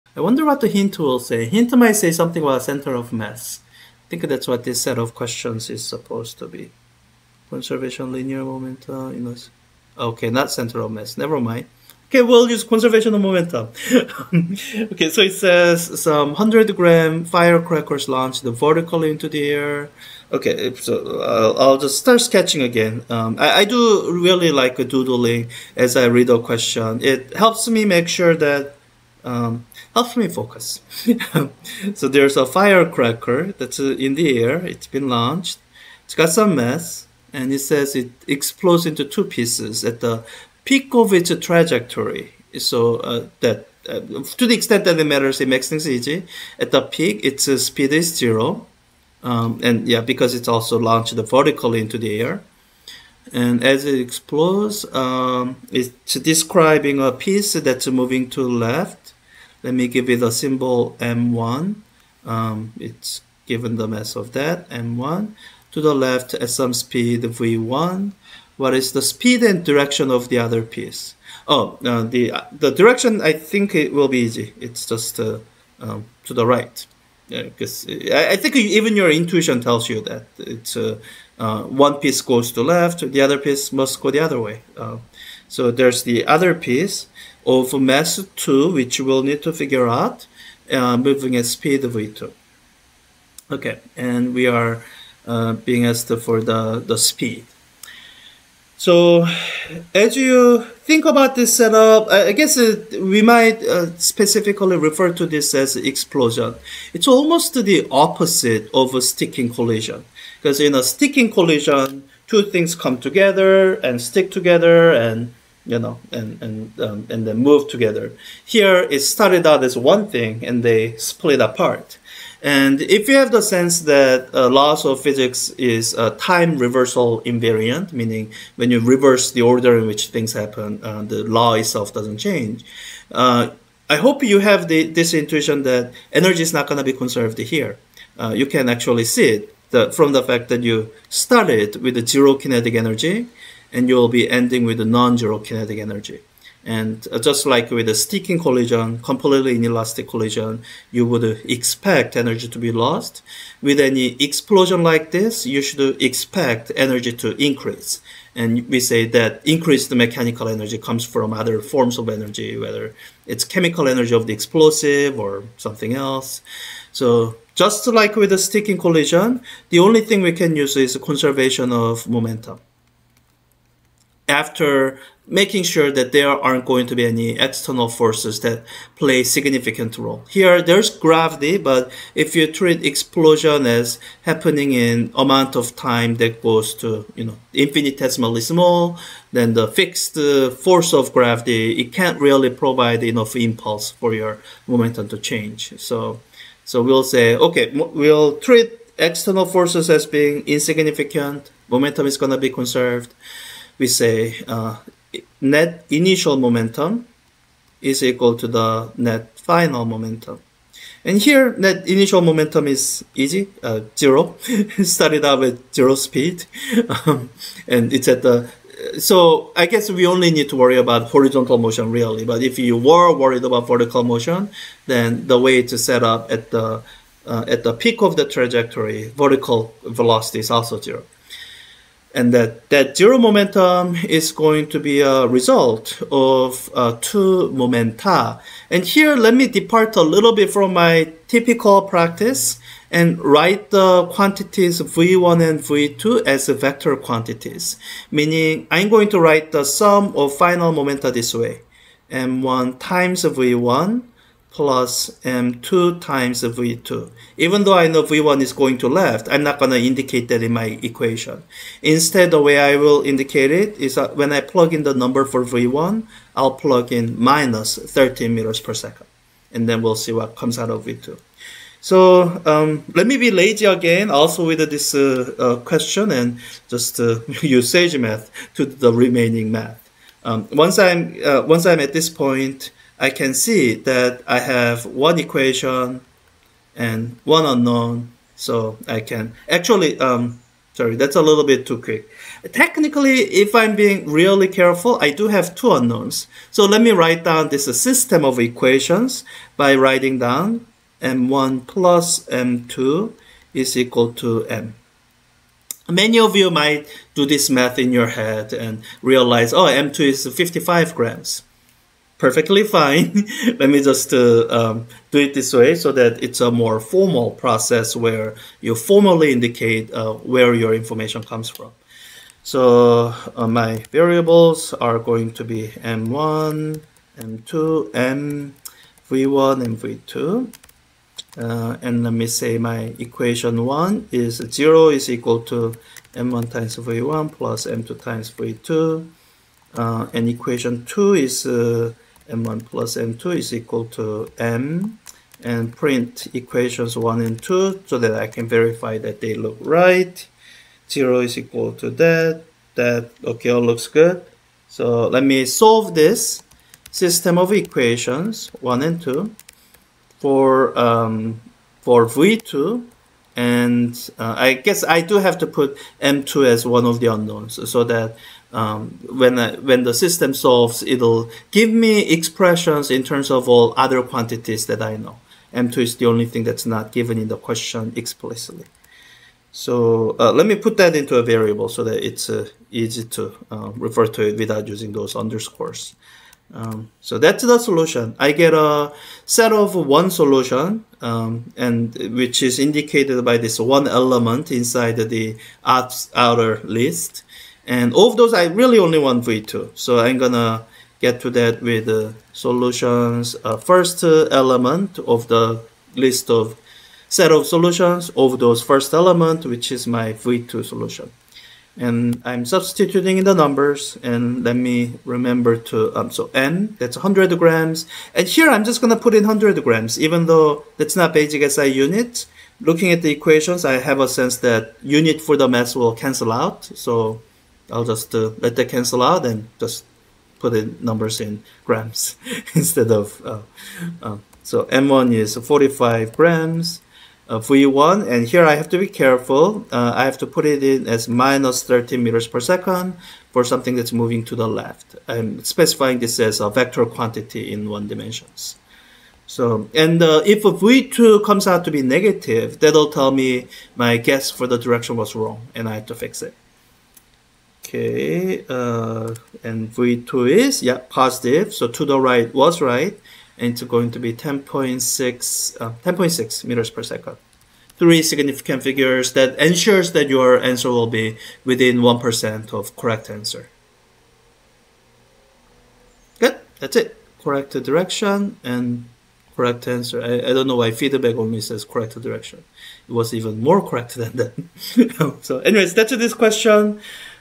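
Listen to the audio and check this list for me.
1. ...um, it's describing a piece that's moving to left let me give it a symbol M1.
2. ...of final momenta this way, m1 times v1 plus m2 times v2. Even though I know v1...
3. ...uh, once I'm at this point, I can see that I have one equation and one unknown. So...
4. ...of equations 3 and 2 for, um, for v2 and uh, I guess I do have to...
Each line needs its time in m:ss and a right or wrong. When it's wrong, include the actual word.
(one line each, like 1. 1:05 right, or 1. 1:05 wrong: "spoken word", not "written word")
1. 0:54 right
2. 4:10 right
3. 4:41 right
4. 5:57 wrong: "1", not "3".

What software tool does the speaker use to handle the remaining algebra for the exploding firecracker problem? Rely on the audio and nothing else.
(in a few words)
SageMath.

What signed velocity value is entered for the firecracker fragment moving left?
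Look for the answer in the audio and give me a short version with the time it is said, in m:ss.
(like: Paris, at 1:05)
-30 m/s, at 7:21.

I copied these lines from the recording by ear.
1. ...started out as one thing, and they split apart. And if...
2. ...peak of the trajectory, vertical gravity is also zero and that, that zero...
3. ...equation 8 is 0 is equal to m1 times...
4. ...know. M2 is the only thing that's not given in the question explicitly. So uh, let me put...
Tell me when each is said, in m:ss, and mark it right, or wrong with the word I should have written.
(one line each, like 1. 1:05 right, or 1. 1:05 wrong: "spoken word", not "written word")
1. 1:58 right
2. 3:47 wrong: "velocity", not "gravity"
3. 5:32 wrong: "1", not "8"
4. 6:14 right.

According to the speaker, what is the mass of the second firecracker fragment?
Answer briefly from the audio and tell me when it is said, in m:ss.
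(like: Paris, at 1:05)
55 grams, at 5:10.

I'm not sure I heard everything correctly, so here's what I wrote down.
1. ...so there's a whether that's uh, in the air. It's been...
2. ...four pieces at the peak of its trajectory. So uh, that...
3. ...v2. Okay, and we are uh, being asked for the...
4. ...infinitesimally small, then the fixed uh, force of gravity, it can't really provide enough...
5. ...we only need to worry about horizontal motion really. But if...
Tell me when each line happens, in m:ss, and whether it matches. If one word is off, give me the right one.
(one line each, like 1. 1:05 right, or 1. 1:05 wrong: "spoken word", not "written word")
1. 0:31 wrong: "firecracker", not "whether"
2. 0:39 wrong: "two", not "four"
3. 1:31 right
4. 3:07 right
5. 3:39 right.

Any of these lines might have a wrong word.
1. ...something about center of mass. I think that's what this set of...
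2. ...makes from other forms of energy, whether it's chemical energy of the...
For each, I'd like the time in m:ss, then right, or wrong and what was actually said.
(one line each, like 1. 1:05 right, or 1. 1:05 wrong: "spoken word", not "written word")
1. 0:02 right
2. 2:40 wrong: "comes", not "makes".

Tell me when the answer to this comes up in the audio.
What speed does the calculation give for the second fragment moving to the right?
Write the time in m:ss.
7:45.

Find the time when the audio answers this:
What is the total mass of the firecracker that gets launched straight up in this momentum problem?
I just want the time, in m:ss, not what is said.
0:16.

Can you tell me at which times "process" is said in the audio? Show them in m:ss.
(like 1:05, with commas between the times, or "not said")
5:17.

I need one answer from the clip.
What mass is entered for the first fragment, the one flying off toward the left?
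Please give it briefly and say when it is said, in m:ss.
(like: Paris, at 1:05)
45 grams, at 7:15.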